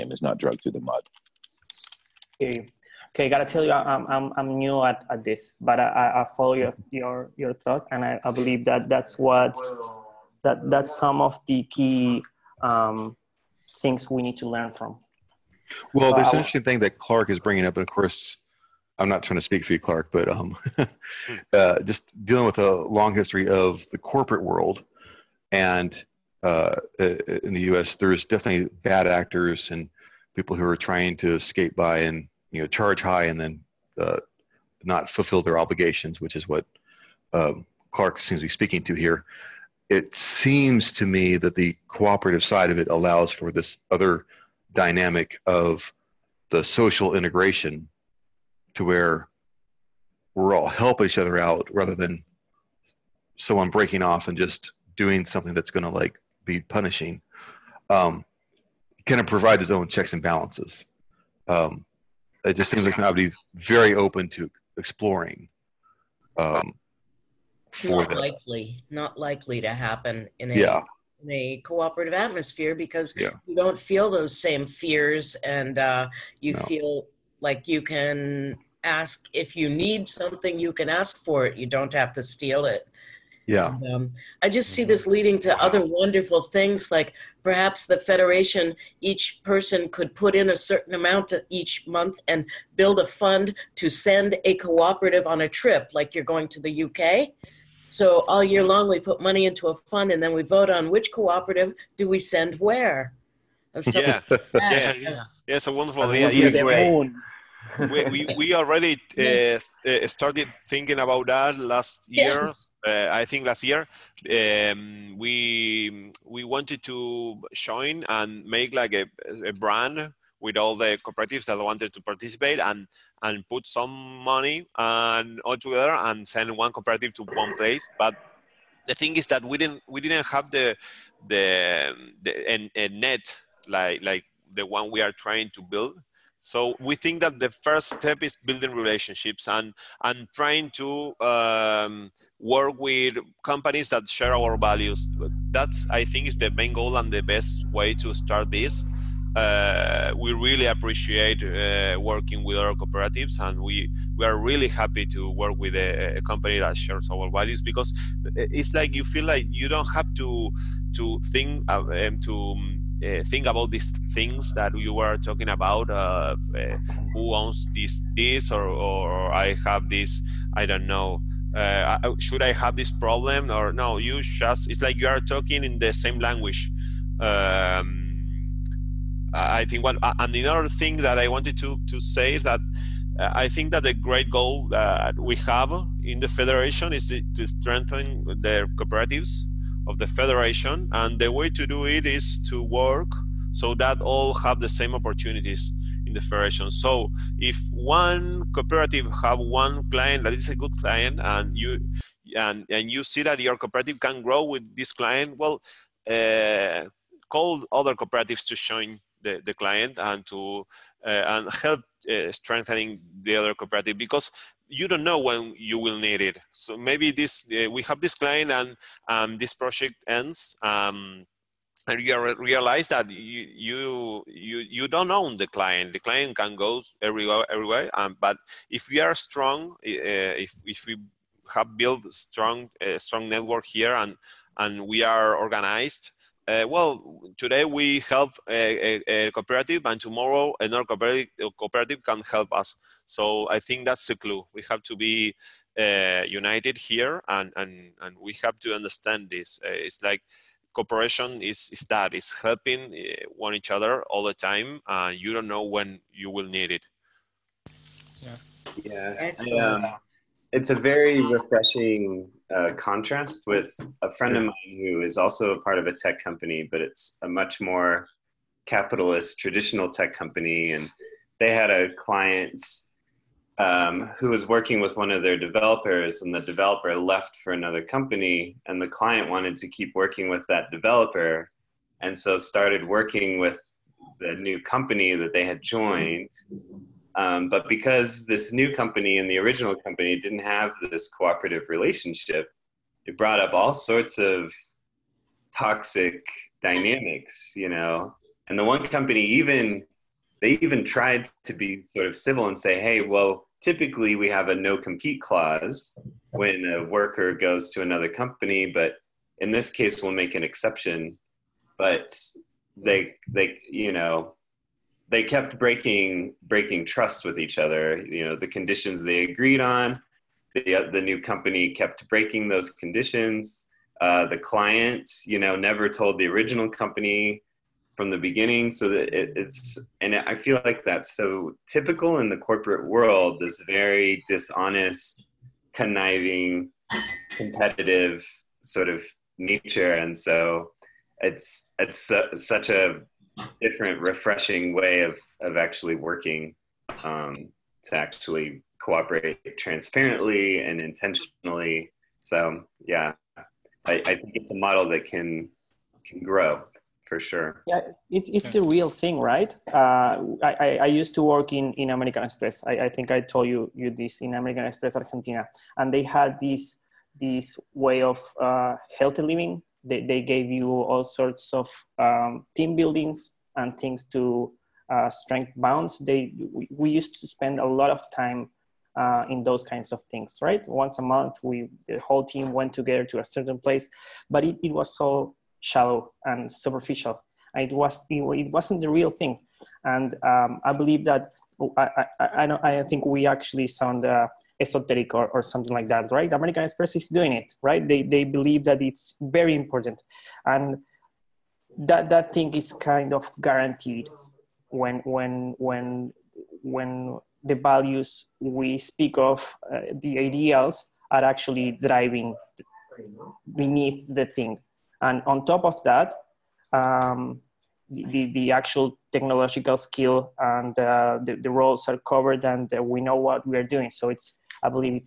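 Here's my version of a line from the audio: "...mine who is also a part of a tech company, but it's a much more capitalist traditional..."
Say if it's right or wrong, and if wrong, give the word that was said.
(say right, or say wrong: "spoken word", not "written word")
right.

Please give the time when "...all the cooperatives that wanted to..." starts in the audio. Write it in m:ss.
2:00.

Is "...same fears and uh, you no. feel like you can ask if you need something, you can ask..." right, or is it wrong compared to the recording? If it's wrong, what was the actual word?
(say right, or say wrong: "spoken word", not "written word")
right.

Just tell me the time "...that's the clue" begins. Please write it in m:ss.
4:03.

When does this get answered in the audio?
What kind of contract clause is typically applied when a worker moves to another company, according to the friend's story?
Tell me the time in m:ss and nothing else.
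5:04.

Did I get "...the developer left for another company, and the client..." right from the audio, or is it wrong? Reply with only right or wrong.
right.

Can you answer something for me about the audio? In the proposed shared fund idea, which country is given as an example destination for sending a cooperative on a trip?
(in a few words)
UK.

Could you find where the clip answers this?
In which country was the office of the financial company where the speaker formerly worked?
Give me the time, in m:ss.
6:04.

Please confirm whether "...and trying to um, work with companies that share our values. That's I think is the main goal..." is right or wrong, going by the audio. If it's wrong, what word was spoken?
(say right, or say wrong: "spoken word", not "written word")
right.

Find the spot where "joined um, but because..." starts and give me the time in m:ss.
4:45.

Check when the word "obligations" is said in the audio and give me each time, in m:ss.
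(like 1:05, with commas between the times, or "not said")
0:35.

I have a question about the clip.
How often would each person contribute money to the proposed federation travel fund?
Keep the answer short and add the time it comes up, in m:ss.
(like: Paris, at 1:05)
Each month, at 1:31.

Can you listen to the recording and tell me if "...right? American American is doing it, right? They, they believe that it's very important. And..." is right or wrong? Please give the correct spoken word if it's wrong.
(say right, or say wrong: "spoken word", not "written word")
wrong: "Express", not "American".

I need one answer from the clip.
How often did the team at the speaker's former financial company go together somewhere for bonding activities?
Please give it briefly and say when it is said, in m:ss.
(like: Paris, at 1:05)
Once a month, at 6:20.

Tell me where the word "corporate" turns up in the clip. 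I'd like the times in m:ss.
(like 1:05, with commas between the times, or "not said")
0:23, 5:32.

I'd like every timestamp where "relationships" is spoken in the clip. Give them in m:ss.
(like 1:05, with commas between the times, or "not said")
2:18, 4:51.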